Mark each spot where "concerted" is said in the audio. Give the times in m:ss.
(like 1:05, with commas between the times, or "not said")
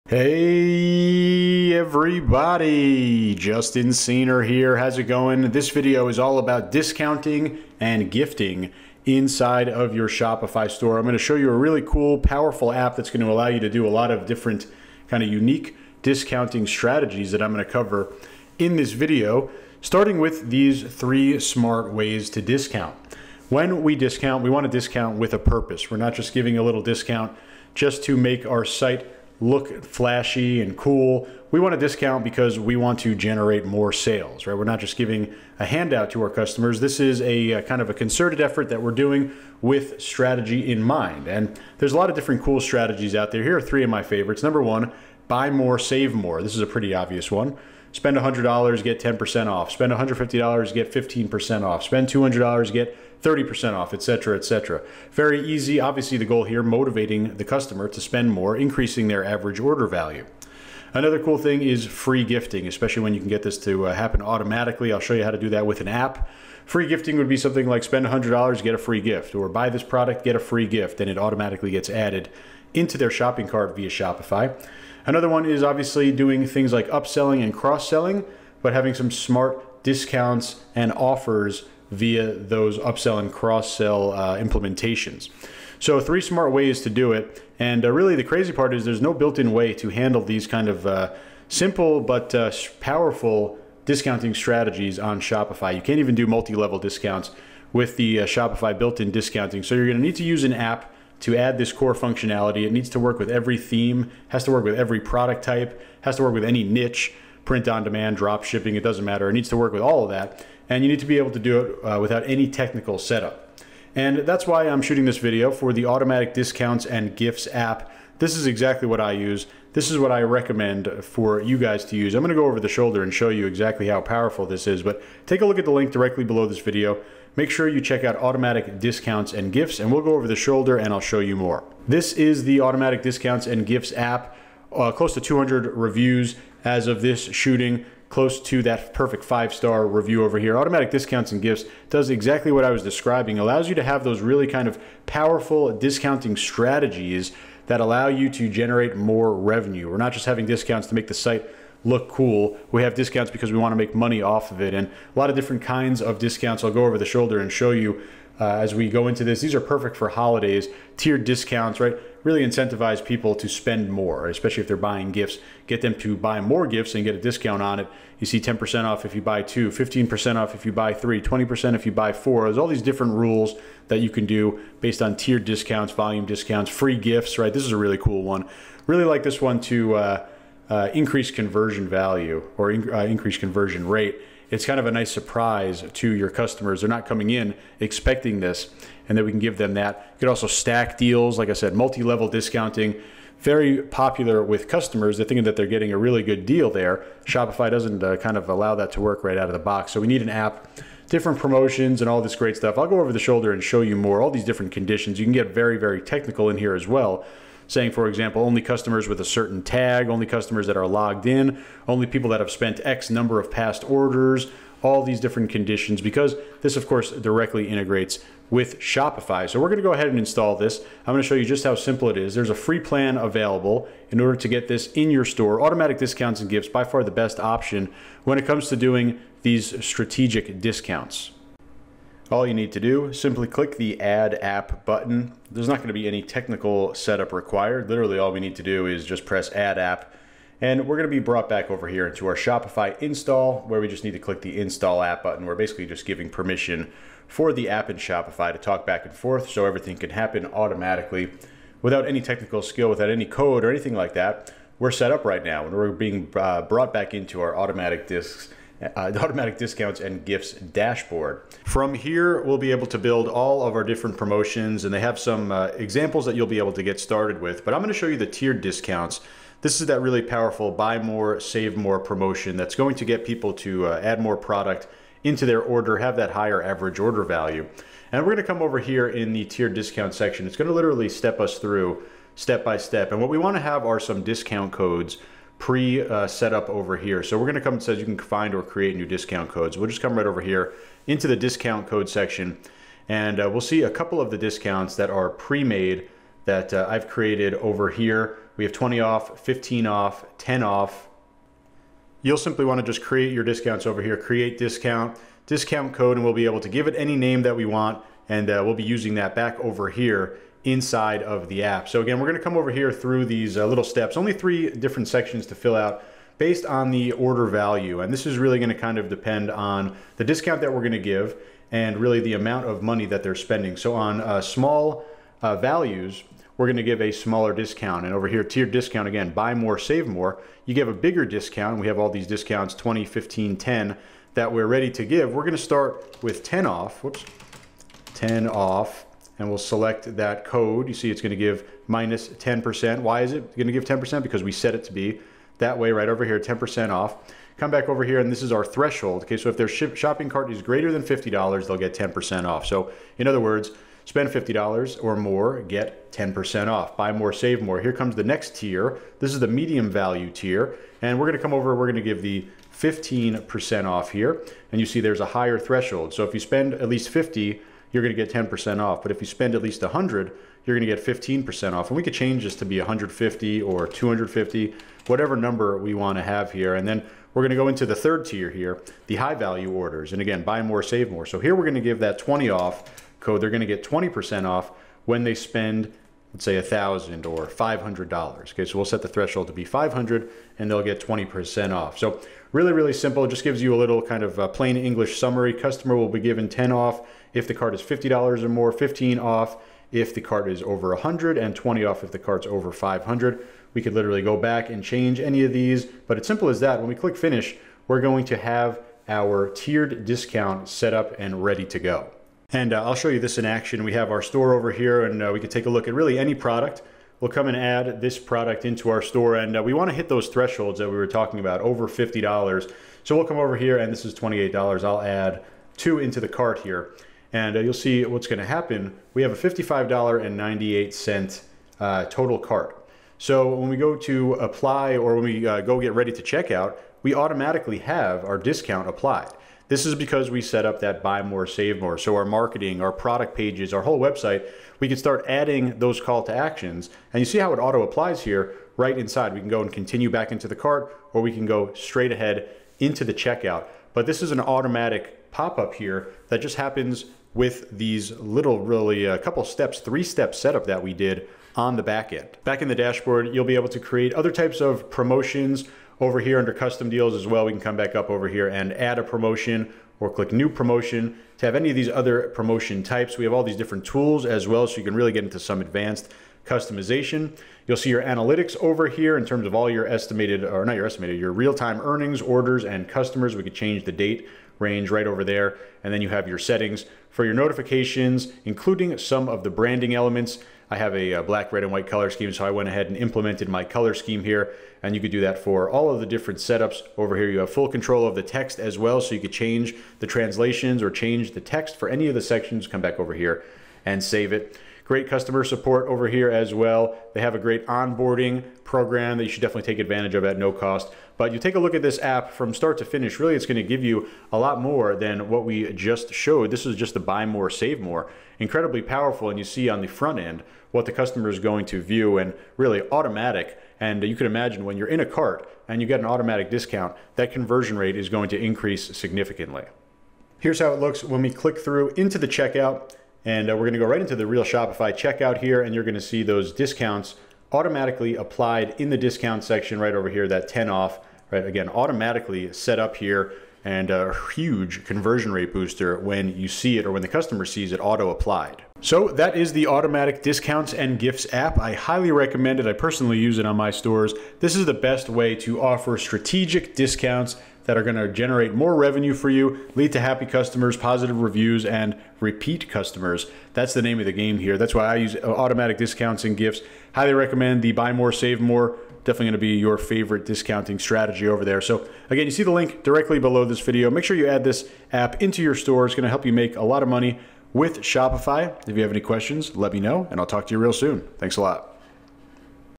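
0:37.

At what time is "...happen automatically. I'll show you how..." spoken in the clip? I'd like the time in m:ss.
1:03.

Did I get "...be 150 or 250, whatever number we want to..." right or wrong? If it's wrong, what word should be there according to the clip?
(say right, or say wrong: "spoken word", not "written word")
right.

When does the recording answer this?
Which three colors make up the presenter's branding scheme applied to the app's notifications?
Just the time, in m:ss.
8:11.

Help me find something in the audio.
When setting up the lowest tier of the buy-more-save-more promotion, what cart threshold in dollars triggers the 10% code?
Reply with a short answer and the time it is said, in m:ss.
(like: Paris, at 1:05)
$50, at 5:50.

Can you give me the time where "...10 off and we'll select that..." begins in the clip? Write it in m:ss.
5:38.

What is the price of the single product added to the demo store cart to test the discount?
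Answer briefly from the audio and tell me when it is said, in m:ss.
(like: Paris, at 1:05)
$28, at 7:04.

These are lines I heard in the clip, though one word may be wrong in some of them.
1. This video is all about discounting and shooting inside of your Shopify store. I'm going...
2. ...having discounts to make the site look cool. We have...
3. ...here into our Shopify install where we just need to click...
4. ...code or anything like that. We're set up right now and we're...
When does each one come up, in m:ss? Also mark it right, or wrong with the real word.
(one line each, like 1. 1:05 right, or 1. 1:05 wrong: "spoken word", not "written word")
1. 0:05 wrong: "gifting", not "shooting"
2. 2:30 right
3. 4:01 right
4. 4:13 right.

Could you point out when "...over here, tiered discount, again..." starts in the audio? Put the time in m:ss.
5:28.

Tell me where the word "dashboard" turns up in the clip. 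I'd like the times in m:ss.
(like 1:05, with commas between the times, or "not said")
4:20, 7:42.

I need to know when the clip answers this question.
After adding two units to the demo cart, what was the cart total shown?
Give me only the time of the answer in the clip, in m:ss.
7:09.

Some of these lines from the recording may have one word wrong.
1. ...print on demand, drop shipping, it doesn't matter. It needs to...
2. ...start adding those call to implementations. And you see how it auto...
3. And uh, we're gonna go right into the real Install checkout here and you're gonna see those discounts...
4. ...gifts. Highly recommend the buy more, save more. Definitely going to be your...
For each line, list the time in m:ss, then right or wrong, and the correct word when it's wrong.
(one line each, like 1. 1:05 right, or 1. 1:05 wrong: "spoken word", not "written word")
1. 1:47 right
2. 7:24 wrong: "actions", not "implementations"
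3. 8:53 wrong: "Shopify", not "Install"
4. 9:26 right.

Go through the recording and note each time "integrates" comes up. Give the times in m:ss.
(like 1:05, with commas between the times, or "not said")
3:37.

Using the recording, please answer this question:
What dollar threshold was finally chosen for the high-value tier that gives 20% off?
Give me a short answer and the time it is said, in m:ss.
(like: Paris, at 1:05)
500, at 6:28.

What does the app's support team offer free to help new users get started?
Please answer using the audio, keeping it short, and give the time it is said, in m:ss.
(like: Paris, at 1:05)
onboarding program, at 8:27.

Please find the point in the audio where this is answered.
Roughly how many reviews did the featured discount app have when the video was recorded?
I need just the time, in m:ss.
2:14.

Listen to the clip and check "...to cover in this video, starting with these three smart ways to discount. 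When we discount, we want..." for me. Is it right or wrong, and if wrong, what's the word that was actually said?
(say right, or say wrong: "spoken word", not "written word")
right.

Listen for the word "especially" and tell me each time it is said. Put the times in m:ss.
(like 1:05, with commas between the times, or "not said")
1:02, 2:44.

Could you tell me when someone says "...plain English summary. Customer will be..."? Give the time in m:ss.
6:34.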